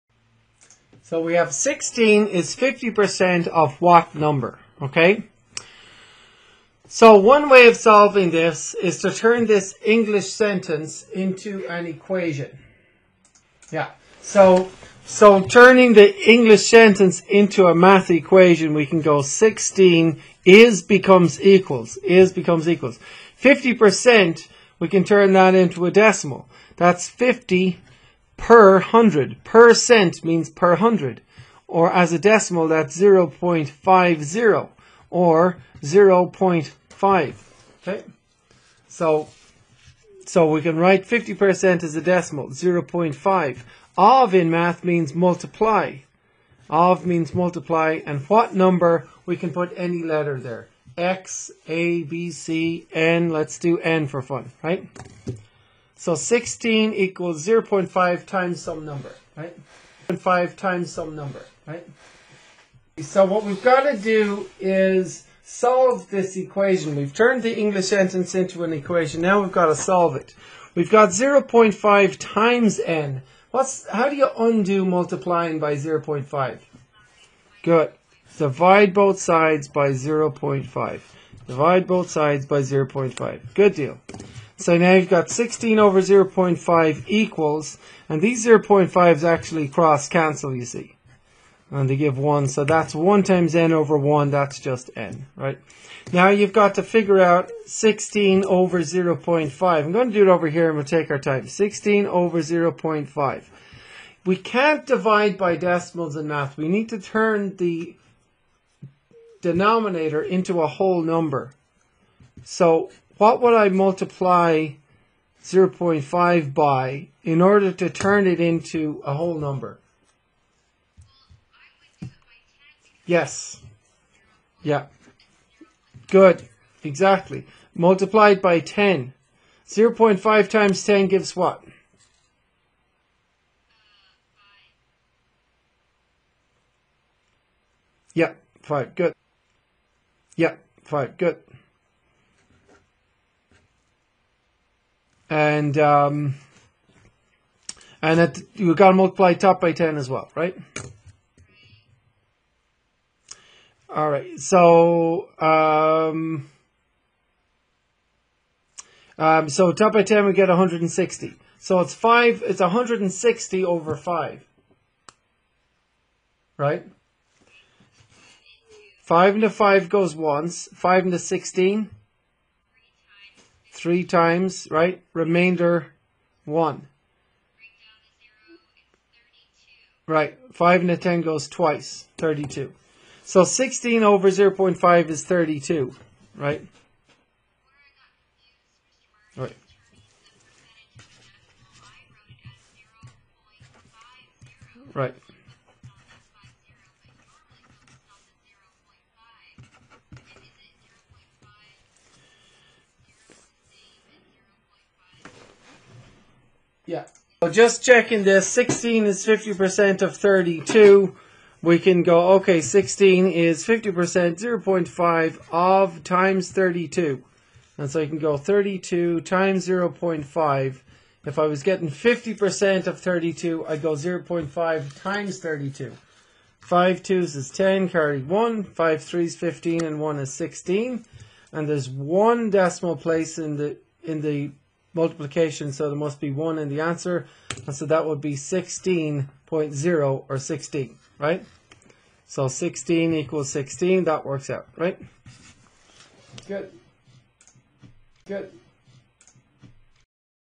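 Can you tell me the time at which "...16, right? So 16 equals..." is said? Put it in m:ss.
4:00.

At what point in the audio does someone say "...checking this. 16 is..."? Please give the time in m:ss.
3:27.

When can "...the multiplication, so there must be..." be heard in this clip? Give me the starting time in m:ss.
3:54.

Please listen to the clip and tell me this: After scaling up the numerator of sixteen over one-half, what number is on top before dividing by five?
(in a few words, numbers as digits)
160.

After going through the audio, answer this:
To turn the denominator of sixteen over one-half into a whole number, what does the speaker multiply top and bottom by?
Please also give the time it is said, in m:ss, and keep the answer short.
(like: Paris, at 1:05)
10, at 2:07.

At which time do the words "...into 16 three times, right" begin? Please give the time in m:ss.
2:51.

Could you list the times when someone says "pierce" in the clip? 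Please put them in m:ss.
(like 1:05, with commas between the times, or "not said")
not said.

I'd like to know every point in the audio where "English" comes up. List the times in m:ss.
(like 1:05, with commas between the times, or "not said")
0:09, 0:16, 1:07.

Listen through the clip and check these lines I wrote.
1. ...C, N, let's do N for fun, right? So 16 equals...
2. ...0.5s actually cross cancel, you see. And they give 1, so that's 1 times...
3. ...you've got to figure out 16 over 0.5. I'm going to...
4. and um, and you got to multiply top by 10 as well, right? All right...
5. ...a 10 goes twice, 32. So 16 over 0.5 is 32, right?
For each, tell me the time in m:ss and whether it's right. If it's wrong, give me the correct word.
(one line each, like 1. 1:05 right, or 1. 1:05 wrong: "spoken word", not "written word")
1. 0:52 right
2. 1:28 right
3. 1:36 right
4. 2:25 right
5. 3:00 right.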